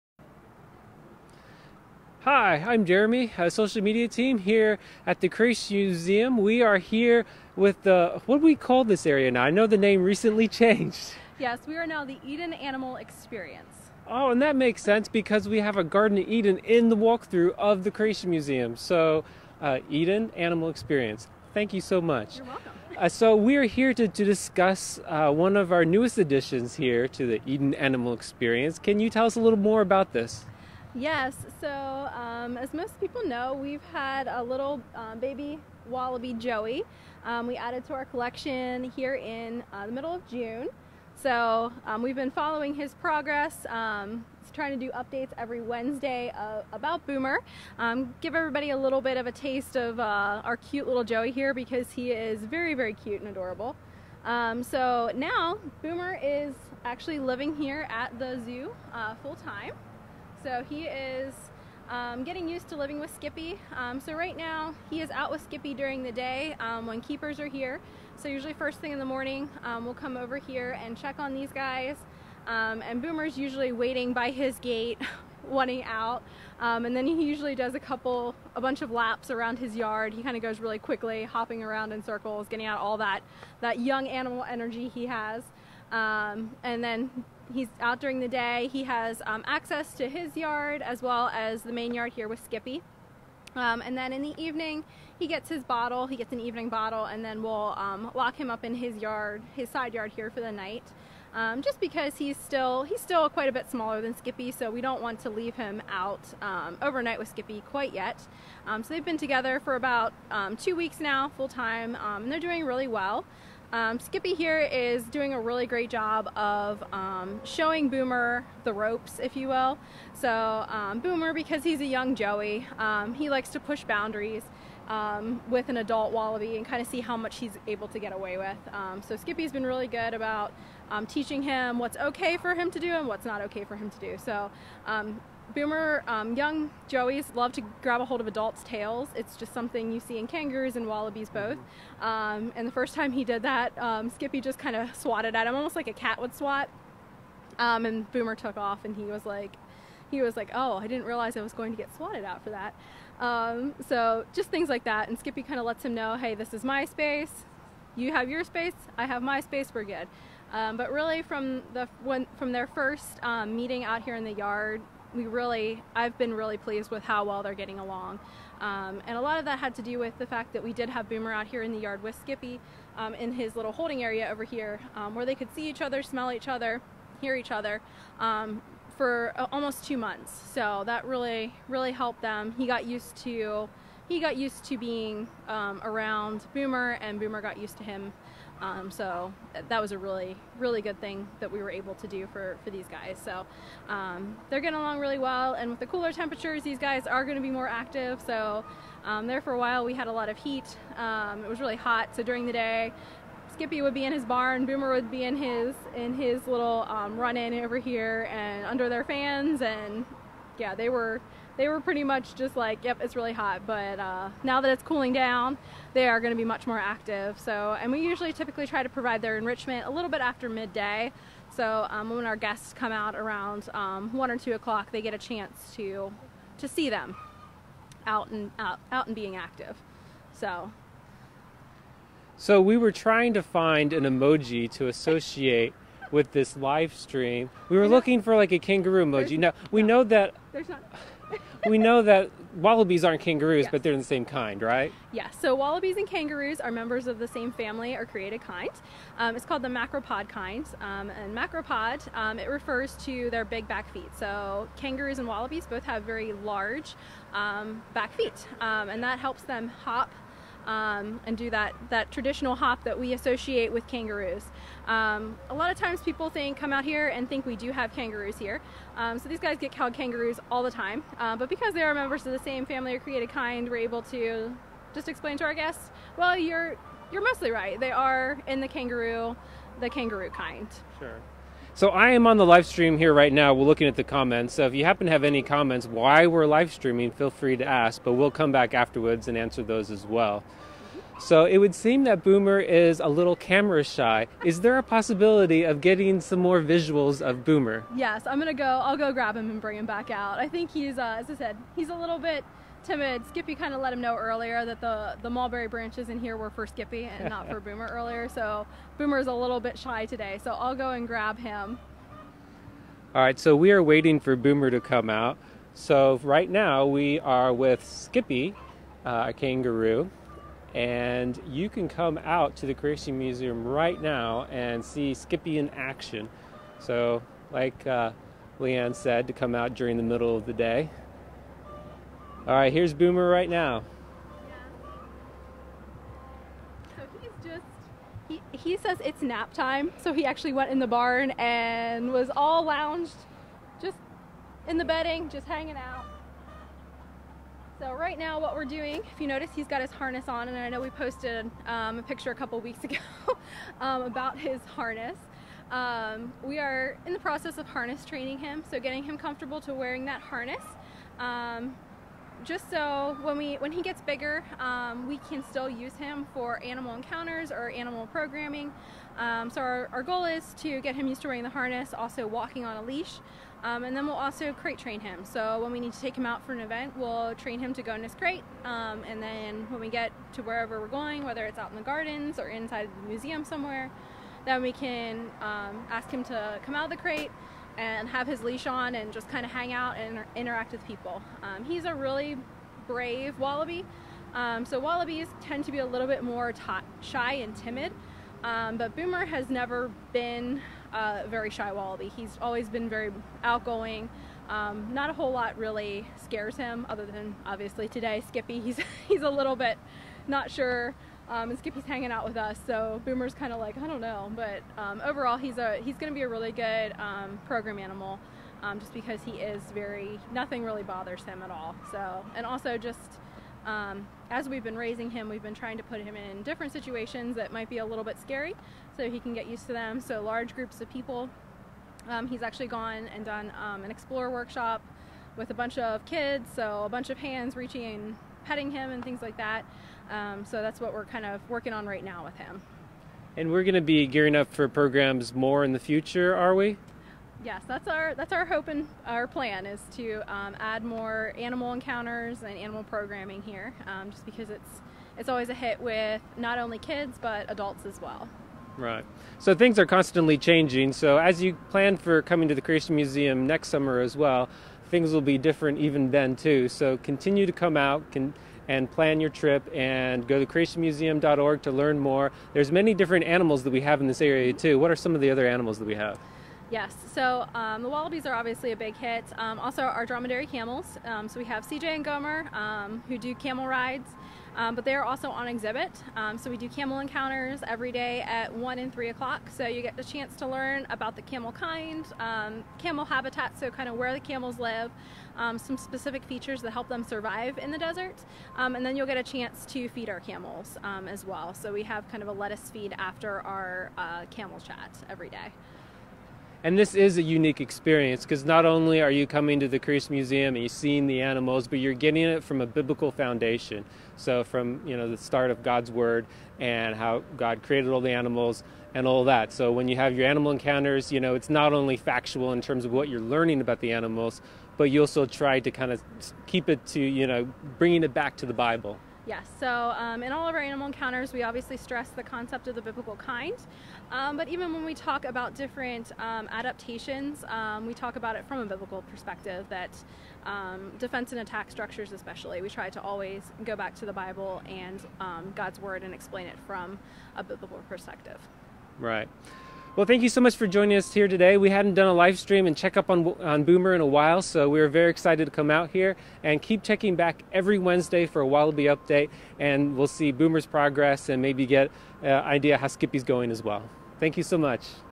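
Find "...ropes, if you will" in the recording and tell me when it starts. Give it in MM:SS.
01:58.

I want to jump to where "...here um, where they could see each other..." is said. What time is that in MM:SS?
02:54.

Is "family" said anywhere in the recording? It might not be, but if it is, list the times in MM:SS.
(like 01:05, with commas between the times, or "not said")
04:07, 04:32.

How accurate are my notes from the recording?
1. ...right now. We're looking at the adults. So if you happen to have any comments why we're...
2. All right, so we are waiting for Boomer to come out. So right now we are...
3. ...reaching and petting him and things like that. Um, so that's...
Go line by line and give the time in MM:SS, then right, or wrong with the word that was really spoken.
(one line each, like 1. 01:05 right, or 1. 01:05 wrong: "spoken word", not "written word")
1. 04:43 wrong: "comments", not "adults"
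2. 05:13 right
3. 07:17 right.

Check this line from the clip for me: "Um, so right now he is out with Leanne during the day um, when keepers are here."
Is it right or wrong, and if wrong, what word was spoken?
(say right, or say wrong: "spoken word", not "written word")
wrong: "Skippy", not "Leanne".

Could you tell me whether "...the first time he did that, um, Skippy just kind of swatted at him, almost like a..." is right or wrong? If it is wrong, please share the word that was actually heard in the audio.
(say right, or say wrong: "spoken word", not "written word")
right.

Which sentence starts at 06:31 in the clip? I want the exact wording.
Um, he's a really brave wallaby.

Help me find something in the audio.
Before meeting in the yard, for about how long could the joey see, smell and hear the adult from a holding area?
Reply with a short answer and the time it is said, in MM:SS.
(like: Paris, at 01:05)
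two months, at 02:59.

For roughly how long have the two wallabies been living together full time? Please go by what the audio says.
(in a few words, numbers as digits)
two weeks.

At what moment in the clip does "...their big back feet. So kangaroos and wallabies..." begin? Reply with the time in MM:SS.
04:13.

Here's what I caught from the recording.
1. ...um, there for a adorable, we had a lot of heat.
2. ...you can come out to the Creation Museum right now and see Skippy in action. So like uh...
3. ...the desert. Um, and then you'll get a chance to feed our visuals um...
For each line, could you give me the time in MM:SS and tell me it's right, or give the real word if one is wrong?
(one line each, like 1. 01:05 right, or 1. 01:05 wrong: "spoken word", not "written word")
1. 03:19 wrong: "while", not "adorable"
2. 05:21 right
3. 08:17 wrong: "camels", not "visuals".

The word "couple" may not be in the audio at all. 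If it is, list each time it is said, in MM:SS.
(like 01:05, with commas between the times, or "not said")
01:17, 05:52.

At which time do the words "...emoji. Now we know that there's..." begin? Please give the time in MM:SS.
03:59.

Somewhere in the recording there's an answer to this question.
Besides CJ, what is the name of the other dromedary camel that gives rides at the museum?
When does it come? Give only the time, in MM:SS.
08:02.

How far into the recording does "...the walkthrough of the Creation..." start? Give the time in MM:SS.
00:16.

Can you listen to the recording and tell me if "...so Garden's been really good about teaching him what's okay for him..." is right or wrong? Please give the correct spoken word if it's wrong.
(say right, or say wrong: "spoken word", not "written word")
wrong: "Skippy", not "Garden".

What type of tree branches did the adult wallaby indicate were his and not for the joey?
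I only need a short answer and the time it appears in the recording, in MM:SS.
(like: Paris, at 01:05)
mulberry, at 05:05.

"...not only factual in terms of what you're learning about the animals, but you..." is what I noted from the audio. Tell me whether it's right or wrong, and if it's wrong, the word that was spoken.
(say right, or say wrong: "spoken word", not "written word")
right.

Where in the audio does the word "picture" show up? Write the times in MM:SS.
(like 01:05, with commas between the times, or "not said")
05:52.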